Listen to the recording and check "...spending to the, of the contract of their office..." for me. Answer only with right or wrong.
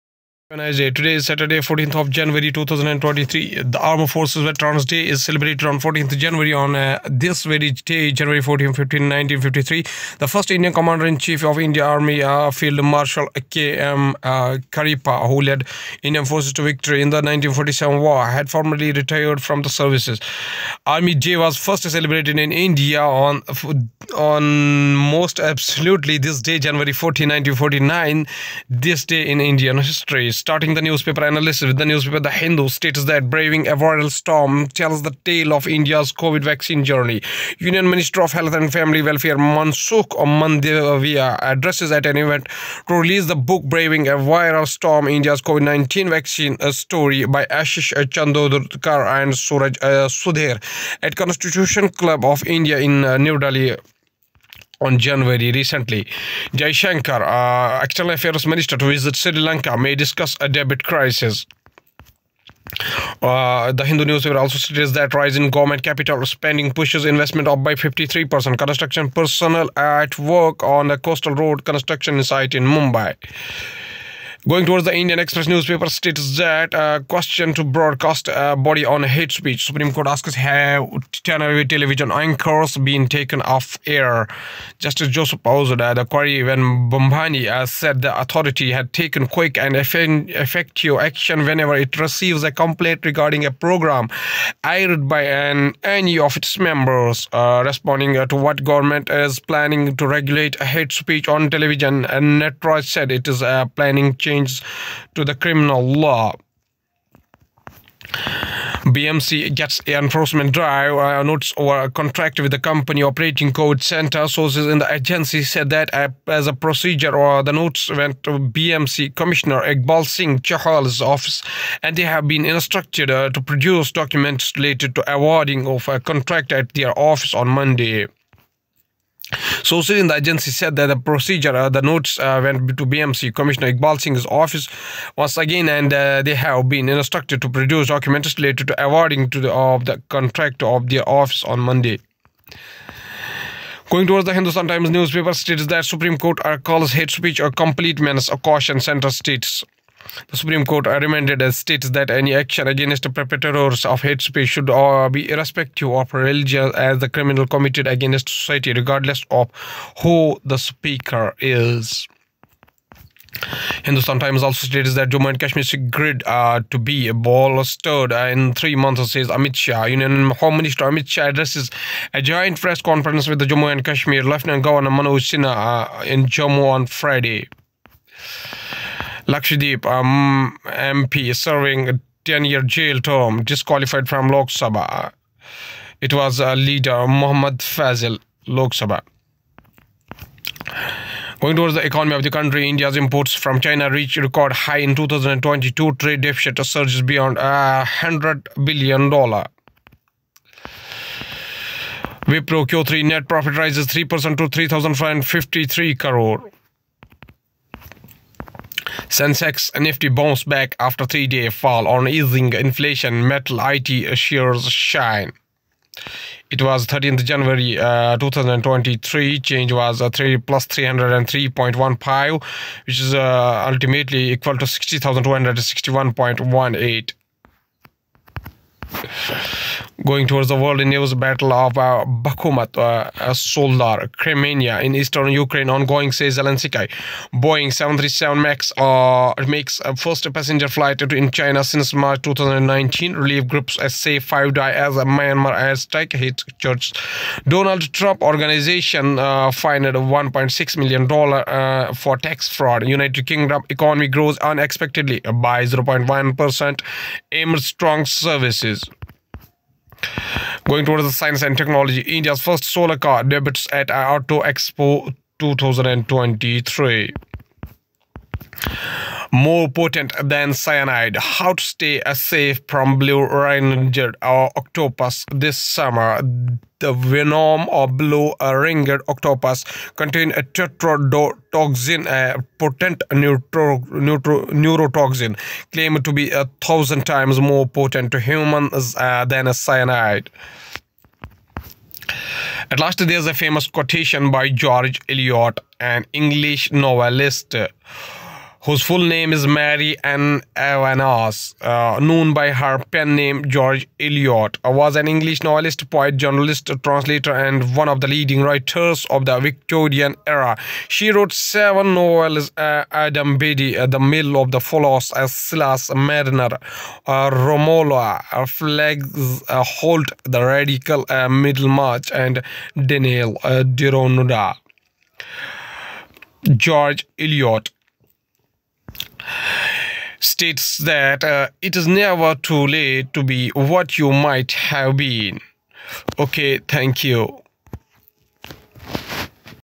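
wrong.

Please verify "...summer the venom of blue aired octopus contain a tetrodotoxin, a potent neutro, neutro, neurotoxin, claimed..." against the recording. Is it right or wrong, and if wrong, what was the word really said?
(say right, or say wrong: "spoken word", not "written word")
wrong: "ringed", not "aired".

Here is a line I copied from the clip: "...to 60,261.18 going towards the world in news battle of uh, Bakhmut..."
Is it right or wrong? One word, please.
right.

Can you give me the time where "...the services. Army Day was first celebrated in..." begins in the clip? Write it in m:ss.
0:19.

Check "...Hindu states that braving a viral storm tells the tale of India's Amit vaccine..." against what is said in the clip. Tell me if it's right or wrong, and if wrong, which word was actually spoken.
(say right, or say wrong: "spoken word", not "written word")
wrong: "COVID", not "Amit".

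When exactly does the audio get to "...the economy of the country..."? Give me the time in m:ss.
3:11.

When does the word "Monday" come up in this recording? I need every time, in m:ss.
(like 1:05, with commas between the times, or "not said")
2:07, 2:21.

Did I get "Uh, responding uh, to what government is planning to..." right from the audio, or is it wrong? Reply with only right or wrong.
right.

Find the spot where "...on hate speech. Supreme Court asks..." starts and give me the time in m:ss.
1:18.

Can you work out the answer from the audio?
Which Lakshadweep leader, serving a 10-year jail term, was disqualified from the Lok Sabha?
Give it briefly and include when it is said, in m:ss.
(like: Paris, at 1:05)
Muhammad Faizal, at 3:07.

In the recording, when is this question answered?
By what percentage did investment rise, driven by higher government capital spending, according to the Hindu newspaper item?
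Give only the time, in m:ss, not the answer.
1:07.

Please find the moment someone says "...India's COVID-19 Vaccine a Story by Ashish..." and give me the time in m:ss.
0:45.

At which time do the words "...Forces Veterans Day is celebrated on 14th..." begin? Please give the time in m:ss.
0:04.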